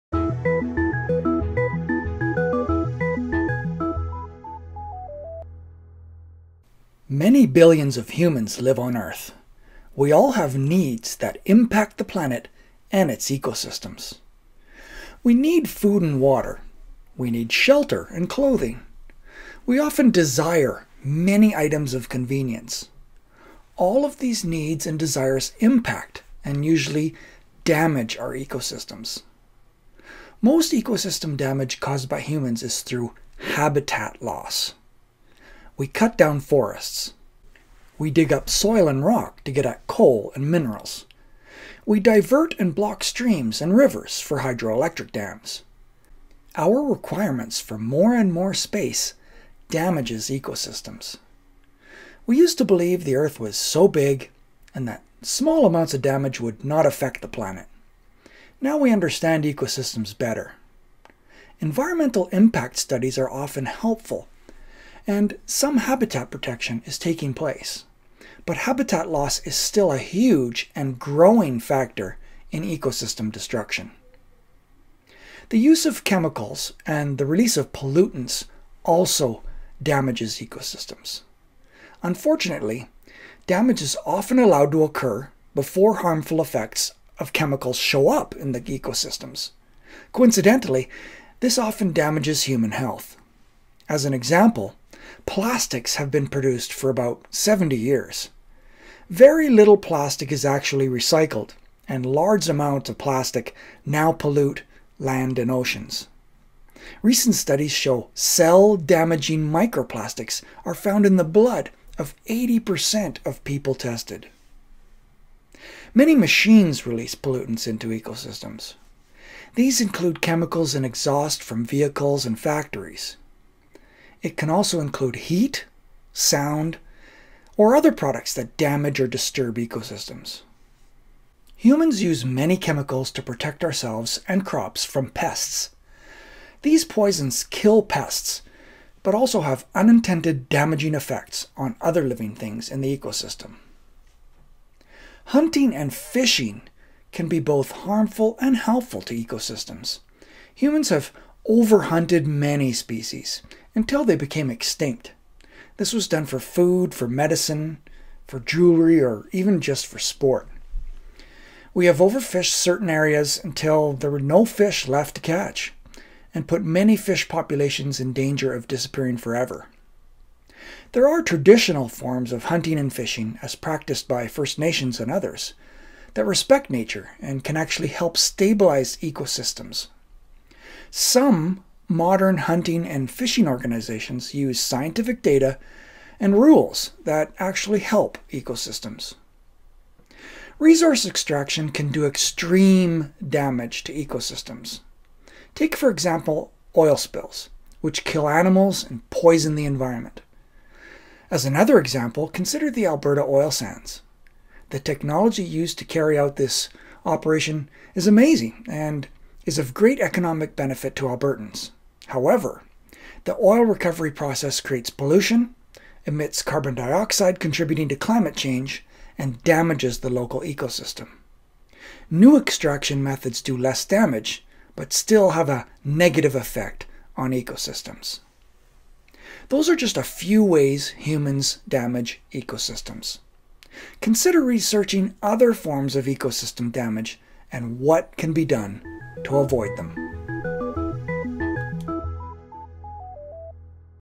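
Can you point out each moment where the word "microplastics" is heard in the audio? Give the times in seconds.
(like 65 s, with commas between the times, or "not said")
109 s.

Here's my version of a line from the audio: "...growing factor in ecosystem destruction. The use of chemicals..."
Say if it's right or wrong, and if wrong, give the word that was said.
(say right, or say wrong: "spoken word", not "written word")
right.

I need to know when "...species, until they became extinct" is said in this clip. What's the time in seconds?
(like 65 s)
152 s.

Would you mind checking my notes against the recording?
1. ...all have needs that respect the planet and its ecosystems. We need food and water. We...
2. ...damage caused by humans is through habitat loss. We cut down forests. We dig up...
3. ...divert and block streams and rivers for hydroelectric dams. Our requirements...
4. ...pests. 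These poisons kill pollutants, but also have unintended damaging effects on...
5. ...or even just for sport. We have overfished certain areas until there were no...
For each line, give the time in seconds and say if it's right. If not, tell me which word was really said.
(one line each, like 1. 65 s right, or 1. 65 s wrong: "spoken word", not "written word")
1. 10 s wrong: "impact", not "respect"
2. 31 s right
3. 41 s right
4. 135 s wrong: "pests", not "pollutants"
5. 159 s right.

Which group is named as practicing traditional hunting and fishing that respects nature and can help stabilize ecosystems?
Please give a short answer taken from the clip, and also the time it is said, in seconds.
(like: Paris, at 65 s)
First Nations, at 174 s.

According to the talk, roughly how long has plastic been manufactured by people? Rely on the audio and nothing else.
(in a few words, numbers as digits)
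70 years.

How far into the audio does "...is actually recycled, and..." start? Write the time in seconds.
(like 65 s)
100 s.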